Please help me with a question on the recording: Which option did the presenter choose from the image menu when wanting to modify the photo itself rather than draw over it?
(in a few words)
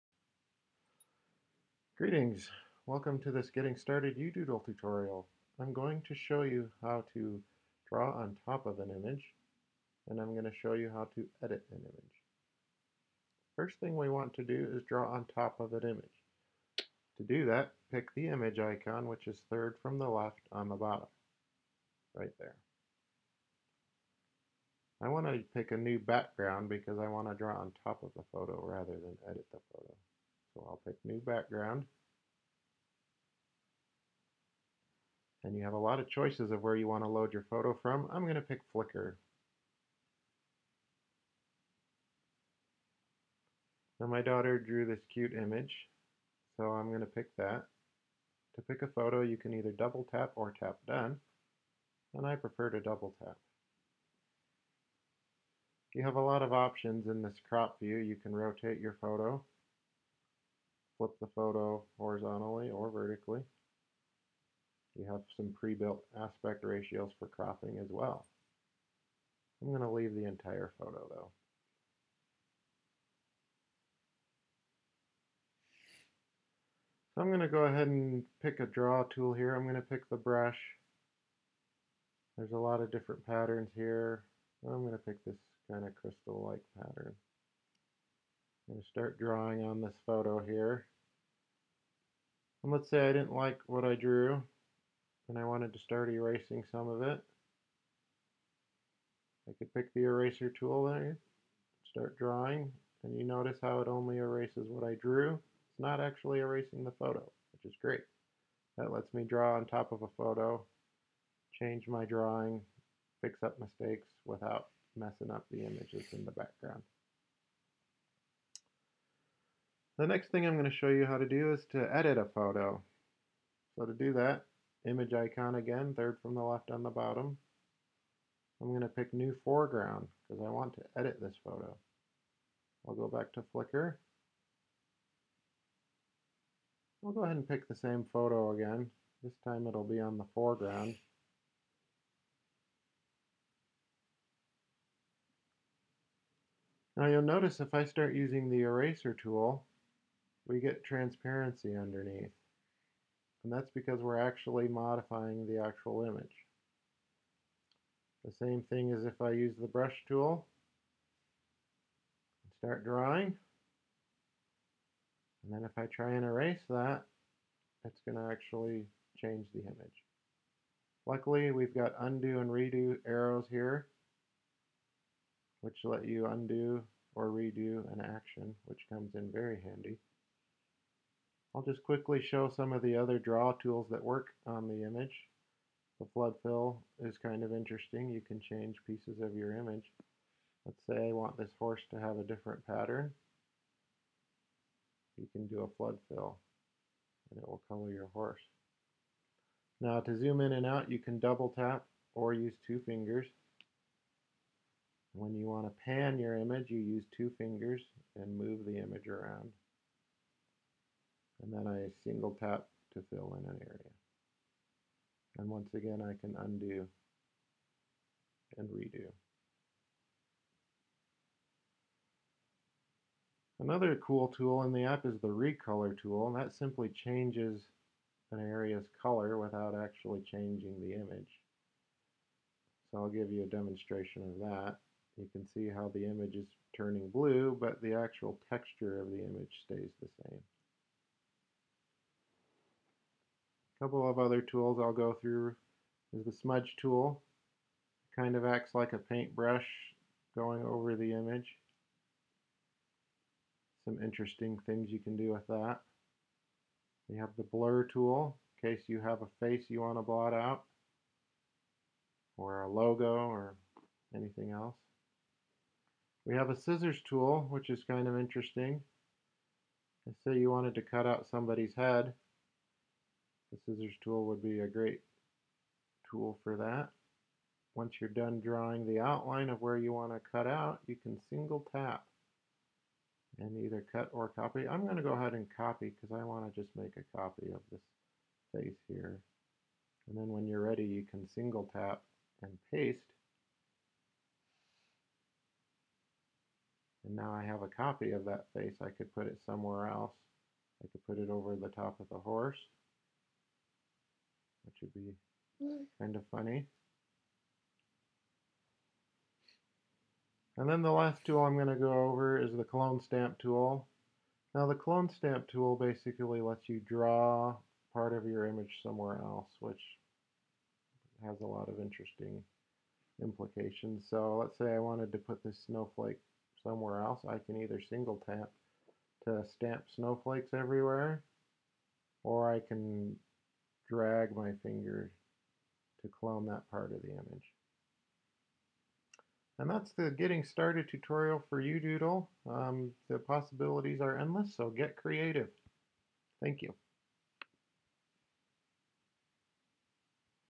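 new foreground.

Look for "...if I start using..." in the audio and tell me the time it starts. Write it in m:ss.
2:27.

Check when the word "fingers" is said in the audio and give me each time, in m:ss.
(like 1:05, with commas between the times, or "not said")
3:22, 3:27, 5:34.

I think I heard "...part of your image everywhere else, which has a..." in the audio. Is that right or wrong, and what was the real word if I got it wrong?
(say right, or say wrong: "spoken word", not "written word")
wrong: "somewhere", not "everywhere".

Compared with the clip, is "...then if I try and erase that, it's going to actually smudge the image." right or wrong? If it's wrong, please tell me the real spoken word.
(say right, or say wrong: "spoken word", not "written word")
wrong: "change", not "smudge".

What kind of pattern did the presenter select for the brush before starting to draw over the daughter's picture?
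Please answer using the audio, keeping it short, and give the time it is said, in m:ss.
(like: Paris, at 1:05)
crystal-like pattern, at 1:25.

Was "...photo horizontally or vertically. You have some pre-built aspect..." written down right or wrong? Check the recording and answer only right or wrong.
right.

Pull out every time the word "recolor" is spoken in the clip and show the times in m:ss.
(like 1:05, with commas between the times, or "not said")
3:45.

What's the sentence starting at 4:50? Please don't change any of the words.
And then when you're ready, you can single tap and paste.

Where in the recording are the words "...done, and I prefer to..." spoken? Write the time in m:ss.
0:50.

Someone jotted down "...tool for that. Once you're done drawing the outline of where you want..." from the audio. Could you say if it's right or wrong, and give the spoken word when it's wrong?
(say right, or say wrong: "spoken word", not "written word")
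right.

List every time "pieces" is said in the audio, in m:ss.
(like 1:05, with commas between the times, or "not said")
3:08.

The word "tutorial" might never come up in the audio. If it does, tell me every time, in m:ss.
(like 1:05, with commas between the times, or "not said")
0:04, 5:40.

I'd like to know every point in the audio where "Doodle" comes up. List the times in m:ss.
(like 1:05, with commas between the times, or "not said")
0:04, 5:41.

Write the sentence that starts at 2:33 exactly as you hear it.
And that's because we're actually modifying the actual image.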